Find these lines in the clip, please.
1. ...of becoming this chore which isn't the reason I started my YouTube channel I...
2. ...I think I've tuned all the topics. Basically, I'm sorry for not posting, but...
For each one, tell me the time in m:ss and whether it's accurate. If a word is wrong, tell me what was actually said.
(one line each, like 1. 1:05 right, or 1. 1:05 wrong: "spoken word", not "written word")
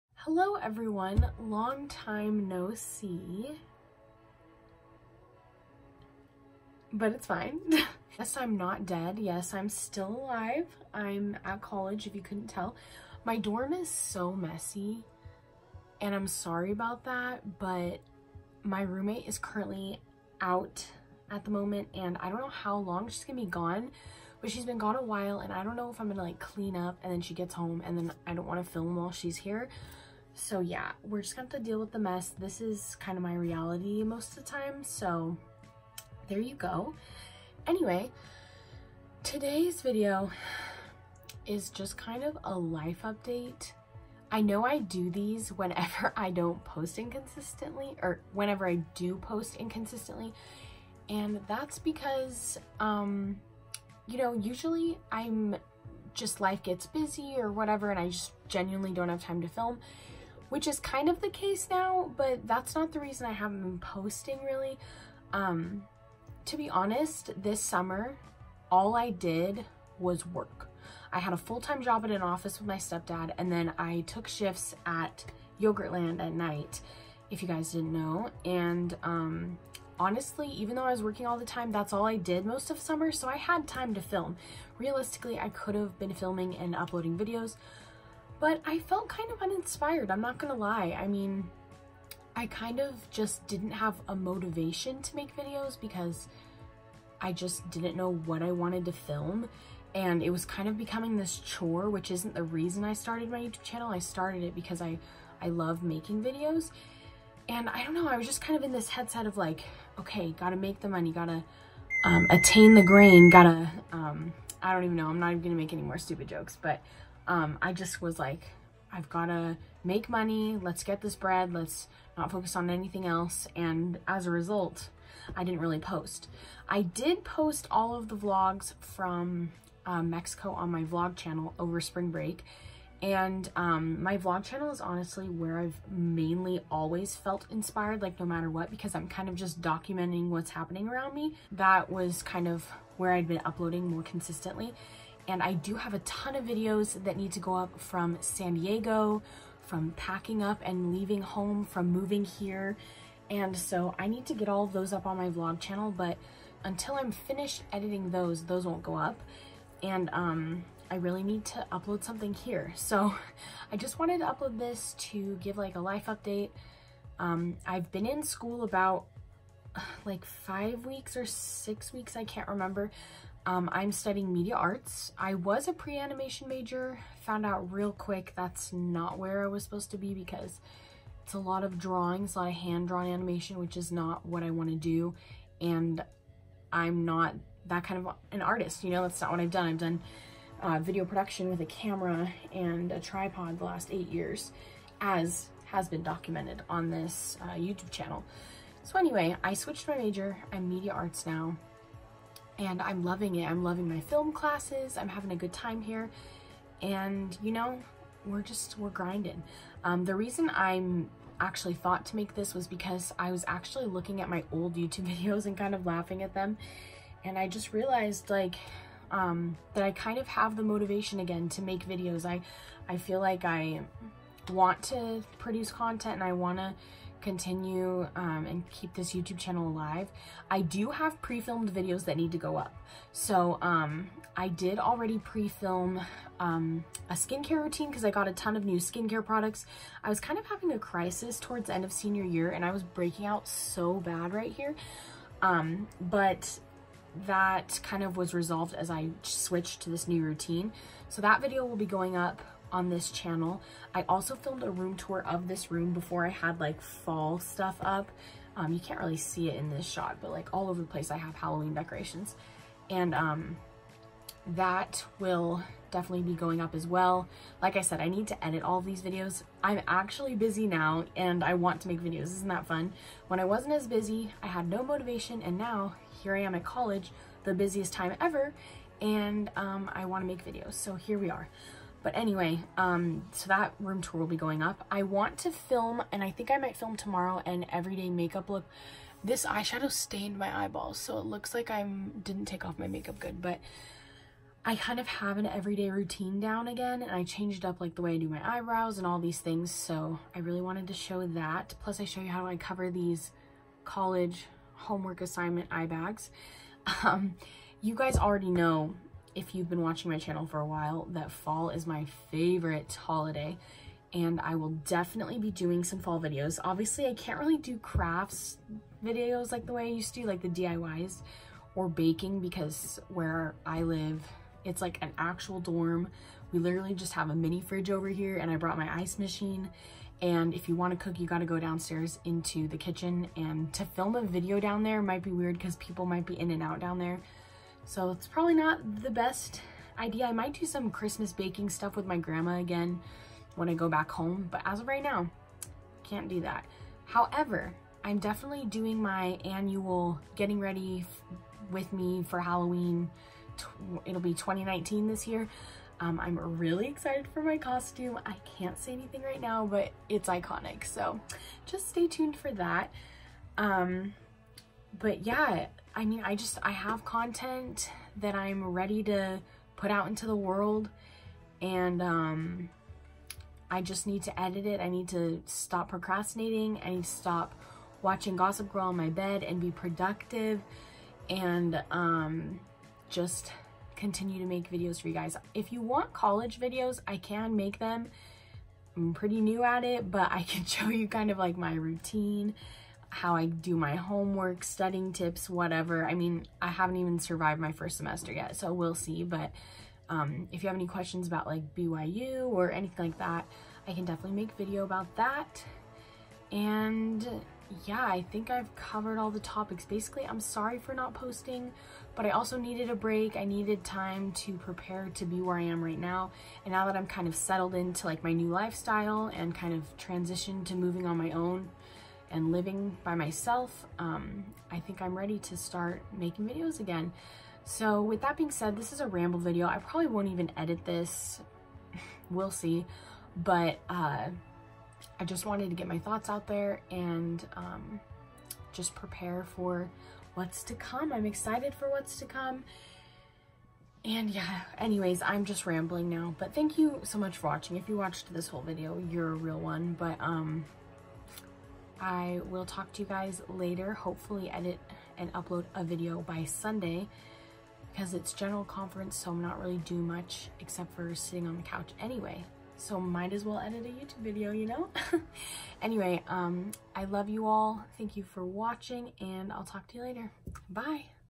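1. 1:40 right
2. 6:48 wrong: "covered", not "tuned".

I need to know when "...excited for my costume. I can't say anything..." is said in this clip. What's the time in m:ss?
5:56.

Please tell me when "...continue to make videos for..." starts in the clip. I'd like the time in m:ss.
6:23.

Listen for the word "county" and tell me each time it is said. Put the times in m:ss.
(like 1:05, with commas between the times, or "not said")
not said.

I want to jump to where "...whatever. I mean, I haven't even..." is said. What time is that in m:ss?
6:35.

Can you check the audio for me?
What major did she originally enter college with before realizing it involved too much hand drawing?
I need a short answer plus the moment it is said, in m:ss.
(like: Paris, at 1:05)
pre-animation, at 2:55.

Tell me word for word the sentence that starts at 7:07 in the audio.
So with that being said, this is a ramble video.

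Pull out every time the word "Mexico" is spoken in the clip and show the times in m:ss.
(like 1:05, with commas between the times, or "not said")
2:10.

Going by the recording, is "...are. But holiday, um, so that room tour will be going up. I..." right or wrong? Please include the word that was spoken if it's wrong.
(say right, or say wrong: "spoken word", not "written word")
wrong: "anyway", not "holiday".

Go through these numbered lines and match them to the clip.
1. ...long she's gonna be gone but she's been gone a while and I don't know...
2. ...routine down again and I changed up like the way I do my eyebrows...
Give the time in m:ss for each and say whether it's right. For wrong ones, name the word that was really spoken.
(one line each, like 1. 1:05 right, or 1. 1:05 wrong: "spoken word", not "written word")
1. 0:22 right
2. 4:55 right.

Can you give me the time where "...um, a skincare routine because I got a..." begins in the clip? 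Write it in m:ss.
3:56.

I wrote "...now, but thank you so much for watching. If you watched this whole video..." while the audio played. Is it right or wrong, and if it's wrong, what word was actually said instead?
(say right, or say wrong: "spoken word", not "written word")
right.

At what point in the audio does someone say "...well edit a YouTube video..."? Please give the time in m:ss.
7:43.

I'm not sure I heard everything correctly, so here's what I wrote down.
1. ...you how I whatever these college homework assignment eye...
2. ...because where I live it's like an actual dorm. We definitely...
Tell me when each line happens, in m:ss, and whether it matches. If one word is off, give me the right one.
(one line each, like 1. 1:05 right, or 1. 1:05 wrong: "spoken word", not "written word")
1. 5:02 wrong: "cover", not "whatever"
2. 5:22 wrong: "literally", not "definitely".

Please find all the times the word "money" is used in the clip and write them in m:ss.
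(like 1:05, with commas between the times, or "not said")
1:50, 2:00.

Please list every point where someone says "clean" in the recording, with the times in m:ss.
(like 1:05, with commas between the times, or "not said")
0:26.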